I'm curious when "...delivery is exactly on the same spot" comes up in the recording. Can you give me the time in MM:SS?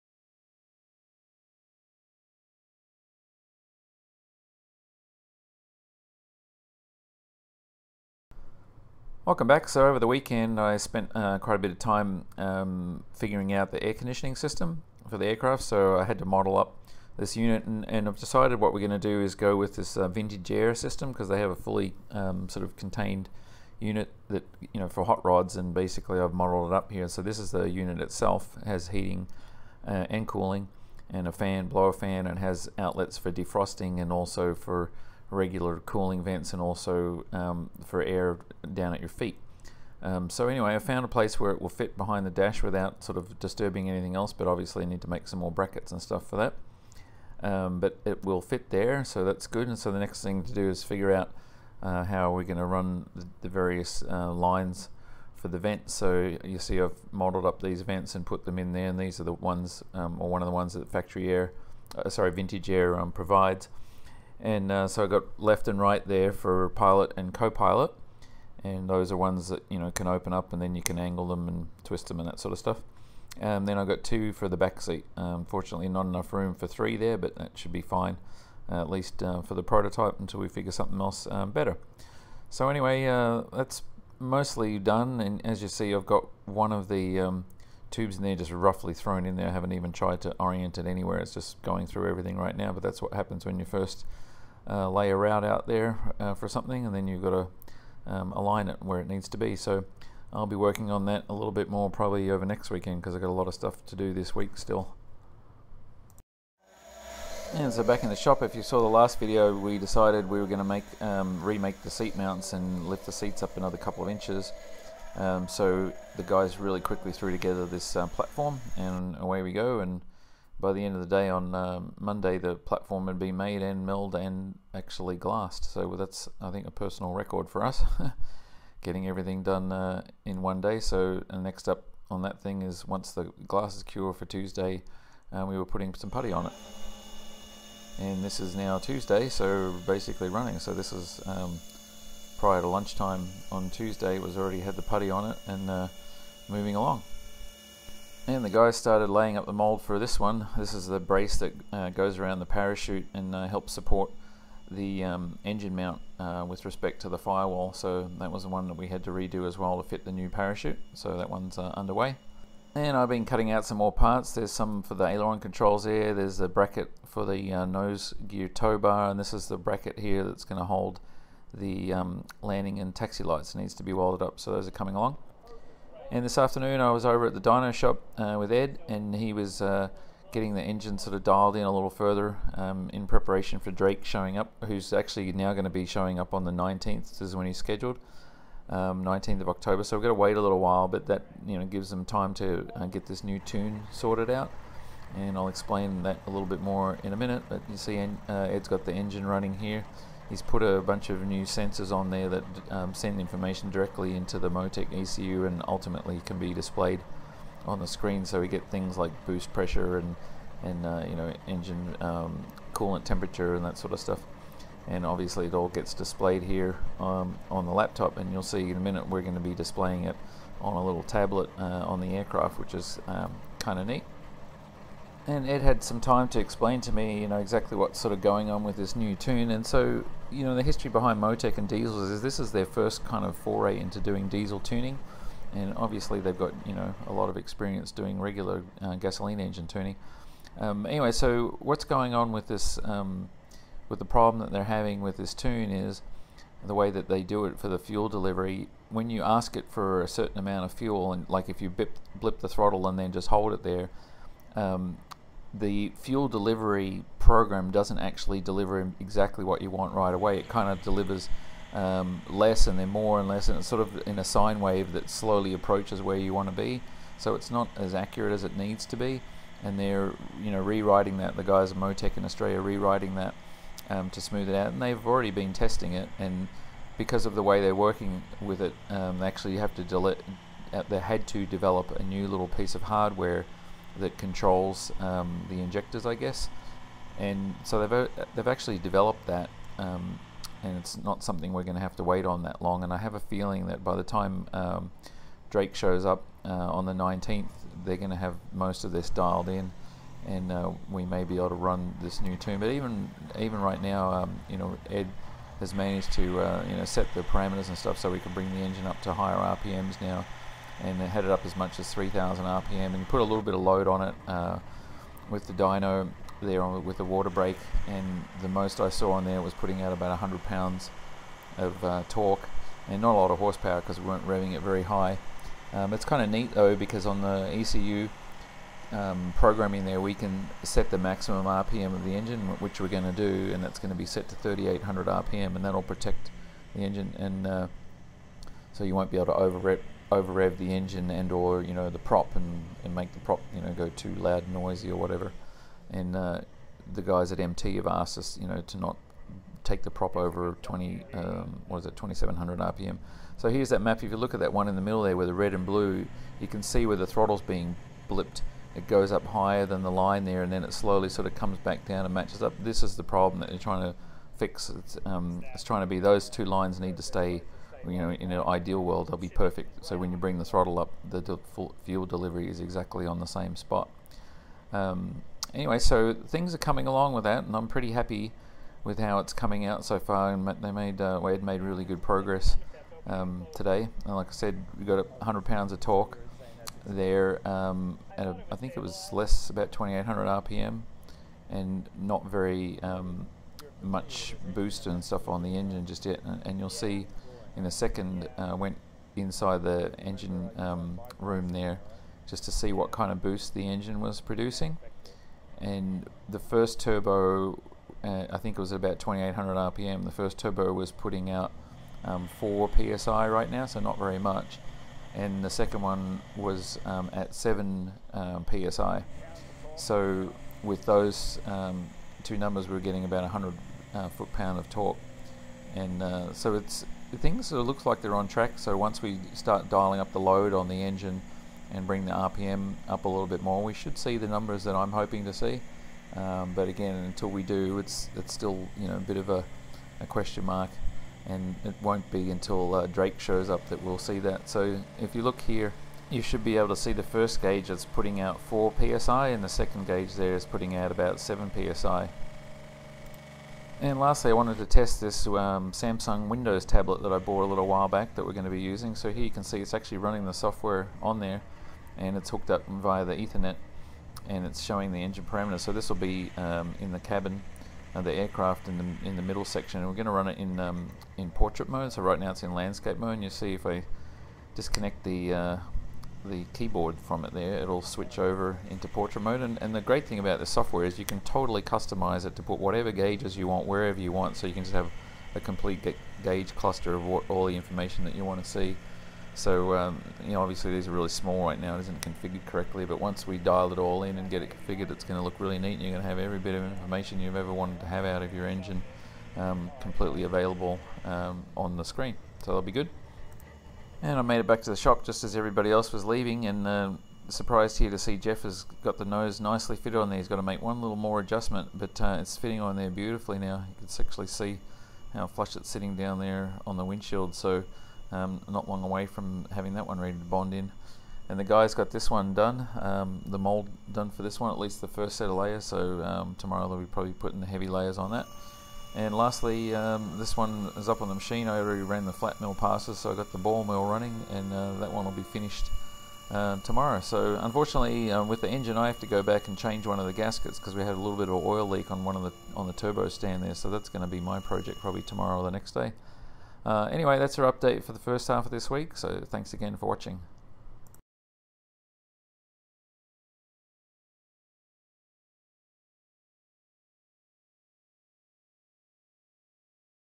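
06:12.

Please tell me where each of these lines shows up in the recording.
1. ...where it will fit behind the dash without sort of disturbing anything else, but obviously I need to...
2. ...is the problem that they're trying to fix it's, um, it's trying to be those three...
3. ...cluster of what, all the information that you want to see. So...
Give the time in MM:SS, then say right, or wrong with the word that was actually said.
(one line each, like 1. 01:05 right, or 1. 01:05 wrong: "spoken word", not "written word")
1. 00:41 right
2. 06:02 wrong: "two", not "three"
3. 08:06 right.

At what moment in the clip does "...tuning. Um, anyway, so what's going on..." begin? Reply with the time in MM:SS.
03:59.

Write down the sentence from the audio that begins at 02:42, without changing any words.
And I've been cutting out some more parts.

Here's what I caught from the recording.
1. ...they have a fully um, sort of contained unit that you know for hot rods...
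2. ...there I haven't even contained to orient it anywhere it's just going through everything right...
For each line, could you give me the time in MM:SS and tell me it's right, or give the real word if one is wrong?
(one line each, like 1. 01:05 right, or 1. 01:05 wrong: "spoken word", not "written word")
1. 00:21 right
2. 01:29 wrong: "tried", not "contained".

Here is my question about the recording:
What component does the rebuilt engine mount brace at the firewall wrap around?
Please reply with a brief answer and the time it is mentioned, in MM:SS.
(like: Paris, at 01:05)
The parachute, at 02:31.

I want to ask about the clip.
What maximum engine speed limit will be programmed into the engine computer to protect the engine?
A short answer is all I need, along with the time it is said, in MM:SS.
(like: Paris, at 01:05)
3800 RPM, at 05:34.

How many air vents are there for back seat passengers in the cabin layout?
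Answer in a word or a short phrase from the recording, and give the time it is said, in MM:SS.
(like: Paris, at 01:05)
2, at 01:14.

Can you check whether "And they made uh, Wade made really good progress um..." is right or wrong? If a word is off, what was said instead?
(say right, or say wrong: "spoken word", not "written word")
right.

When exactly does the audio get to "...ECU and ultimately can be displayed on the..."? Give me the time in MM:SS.
03:24.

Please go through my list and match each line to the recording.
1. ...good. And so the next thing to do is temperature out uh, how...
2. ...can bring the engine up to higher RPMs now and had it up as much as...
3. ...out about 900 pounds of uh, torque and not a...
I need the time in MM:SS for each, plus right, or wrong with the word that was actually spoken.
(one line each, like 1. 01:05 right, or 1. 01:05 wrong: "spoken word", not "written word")
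1. 00:49 wrong: "figure", not "temperature"
2. 05:08 right
3. 05:19 wrong: "100", not "900".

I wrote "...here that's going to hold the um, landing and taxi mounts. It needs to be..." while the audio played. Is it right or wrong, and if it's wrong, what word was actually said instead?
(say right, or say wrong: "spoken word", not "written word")
wrong: "lights", not "mounts".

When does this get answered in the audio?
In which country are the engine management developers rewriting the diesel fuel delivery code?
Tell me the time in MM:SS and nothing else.
04:32.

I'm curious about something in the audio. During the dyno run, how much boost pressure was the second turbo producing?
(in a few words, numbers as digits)
7 psi.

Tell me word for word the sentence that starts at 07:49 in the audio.
And we're going to run it in, um, in portrait mode.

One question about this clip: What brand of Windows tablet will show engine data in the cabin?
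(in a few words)
Samsung.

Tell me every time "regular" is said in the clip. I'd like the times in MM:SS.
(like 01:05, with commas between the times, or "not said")
00:35, 03:58.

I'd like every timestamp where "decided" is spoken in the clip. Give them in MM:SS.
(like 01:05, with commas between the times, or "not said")
00:18, 01:49.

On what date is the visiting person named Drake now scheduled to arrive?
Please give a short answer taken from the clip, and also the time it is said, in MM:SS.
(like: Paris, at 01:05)
October 19, at 03:09.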